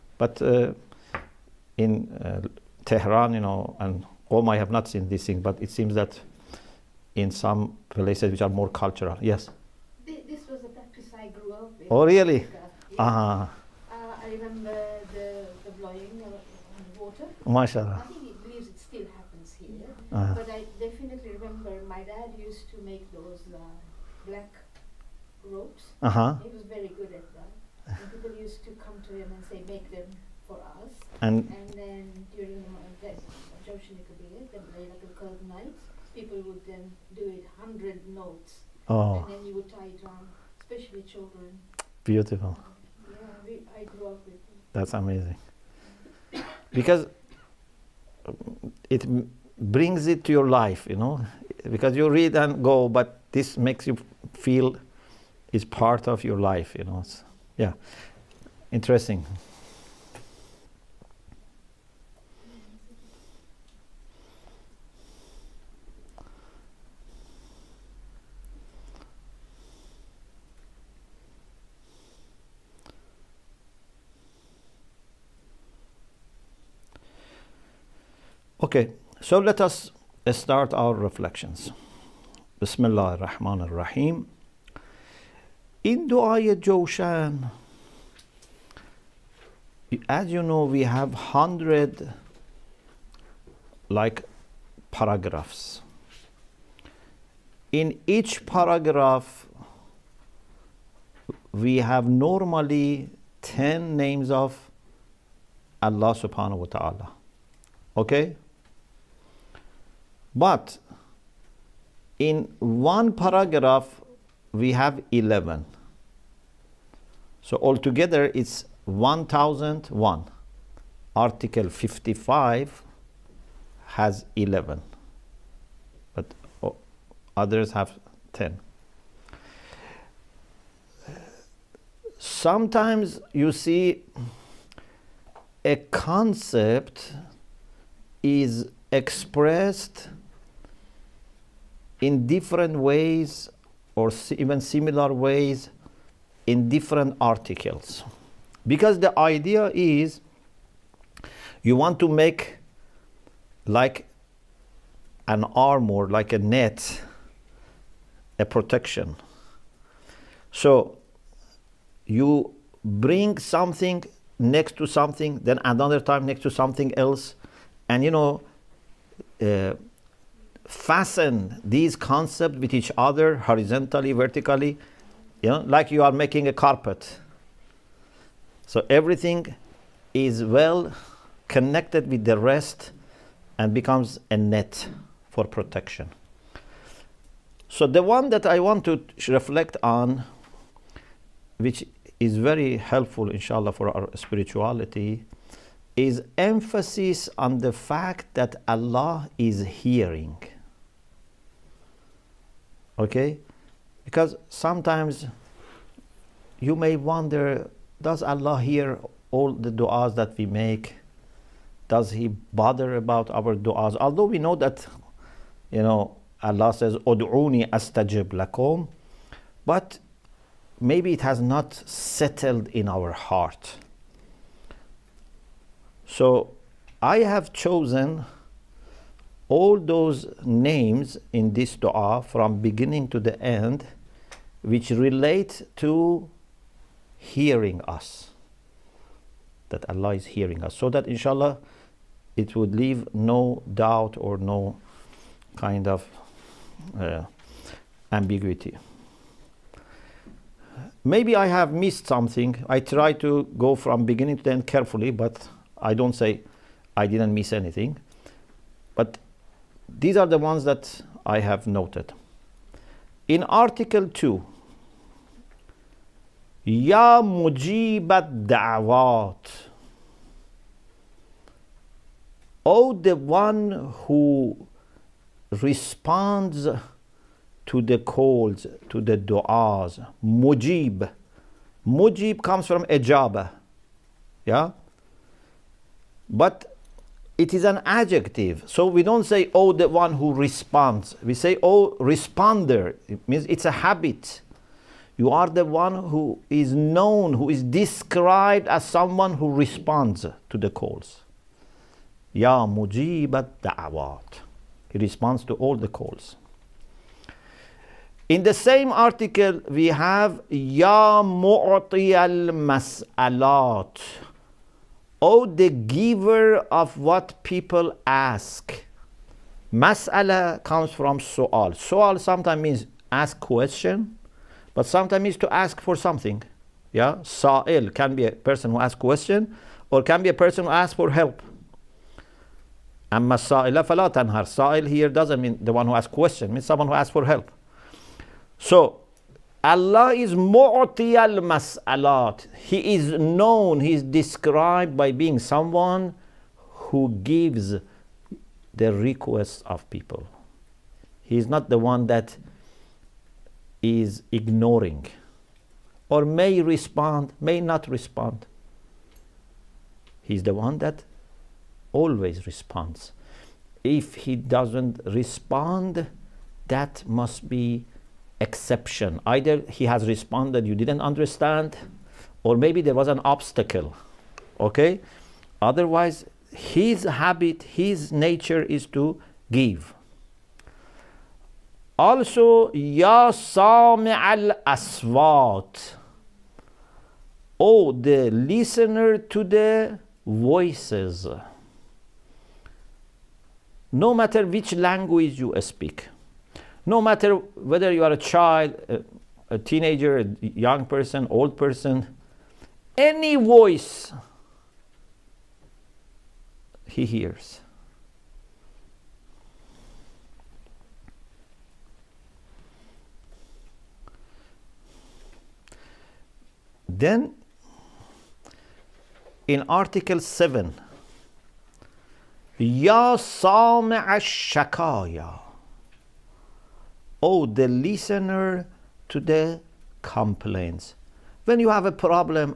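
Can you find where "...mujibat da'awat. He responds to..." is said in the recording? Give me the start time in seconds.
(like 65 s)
302 s.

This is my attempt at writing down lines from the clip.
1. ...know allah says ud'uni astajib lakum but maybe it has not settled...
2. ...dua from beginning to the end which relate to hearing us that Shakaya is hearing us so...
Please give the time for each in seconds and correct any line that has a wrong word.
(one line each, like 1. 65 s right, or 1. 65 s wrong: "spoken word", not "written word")
1. 215 s right
2. 231 s wrong: "Allah", not "Shakaya".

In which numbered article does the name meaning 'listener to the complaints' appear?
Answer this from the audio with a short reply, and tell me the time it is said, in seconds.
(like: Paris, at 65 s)
Article 7, at 419 s.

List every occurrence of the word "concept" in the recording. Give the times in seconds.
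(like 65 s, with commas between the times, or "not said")
135 s, 171 s.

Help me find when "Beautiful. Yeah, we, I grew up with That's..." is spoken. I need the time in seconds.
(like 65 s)
42 s.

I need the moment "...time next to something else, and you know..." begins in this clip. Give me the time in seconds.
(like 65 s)
165 s.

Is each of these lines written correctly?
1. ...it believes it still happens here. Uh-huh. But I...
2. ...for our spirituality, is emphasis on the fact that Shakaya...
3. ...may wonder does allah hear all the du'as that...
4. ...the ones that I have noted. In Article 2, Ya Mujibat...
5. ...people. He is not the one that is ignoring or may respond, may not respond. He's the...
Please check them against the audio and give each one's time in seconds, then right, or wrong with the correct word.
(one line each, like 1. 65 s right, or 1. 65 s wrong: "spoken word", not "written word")
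1. 18 s right
2. 193 s wrong: "Allah", not "Shakaya"
3. 206 s right
4. 260 s right
5. 349 s right.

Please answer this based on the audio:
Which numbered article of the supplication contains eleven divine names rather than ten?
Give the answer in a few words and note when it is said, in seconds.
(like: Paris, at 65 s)
Article 55, at 121 s.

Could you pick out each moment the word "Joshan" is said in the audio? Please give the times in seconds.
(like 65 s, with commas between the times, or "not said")
33 s, 86 s.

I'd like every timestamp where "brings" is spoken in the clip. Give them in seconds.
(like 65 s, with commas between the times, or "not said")
49 s, 162 s.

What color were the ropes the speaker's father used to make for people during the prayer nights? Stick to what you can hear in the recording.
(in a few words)
Black.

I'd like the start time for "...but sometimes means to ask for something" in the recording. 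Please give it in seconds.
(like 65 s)
324 s.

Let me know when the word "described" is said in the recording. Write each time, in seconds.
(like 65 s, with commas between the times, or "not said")
297 s, 344 s.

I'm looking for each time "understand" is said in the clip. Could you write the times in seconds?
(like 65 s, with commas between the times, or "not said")
371 s.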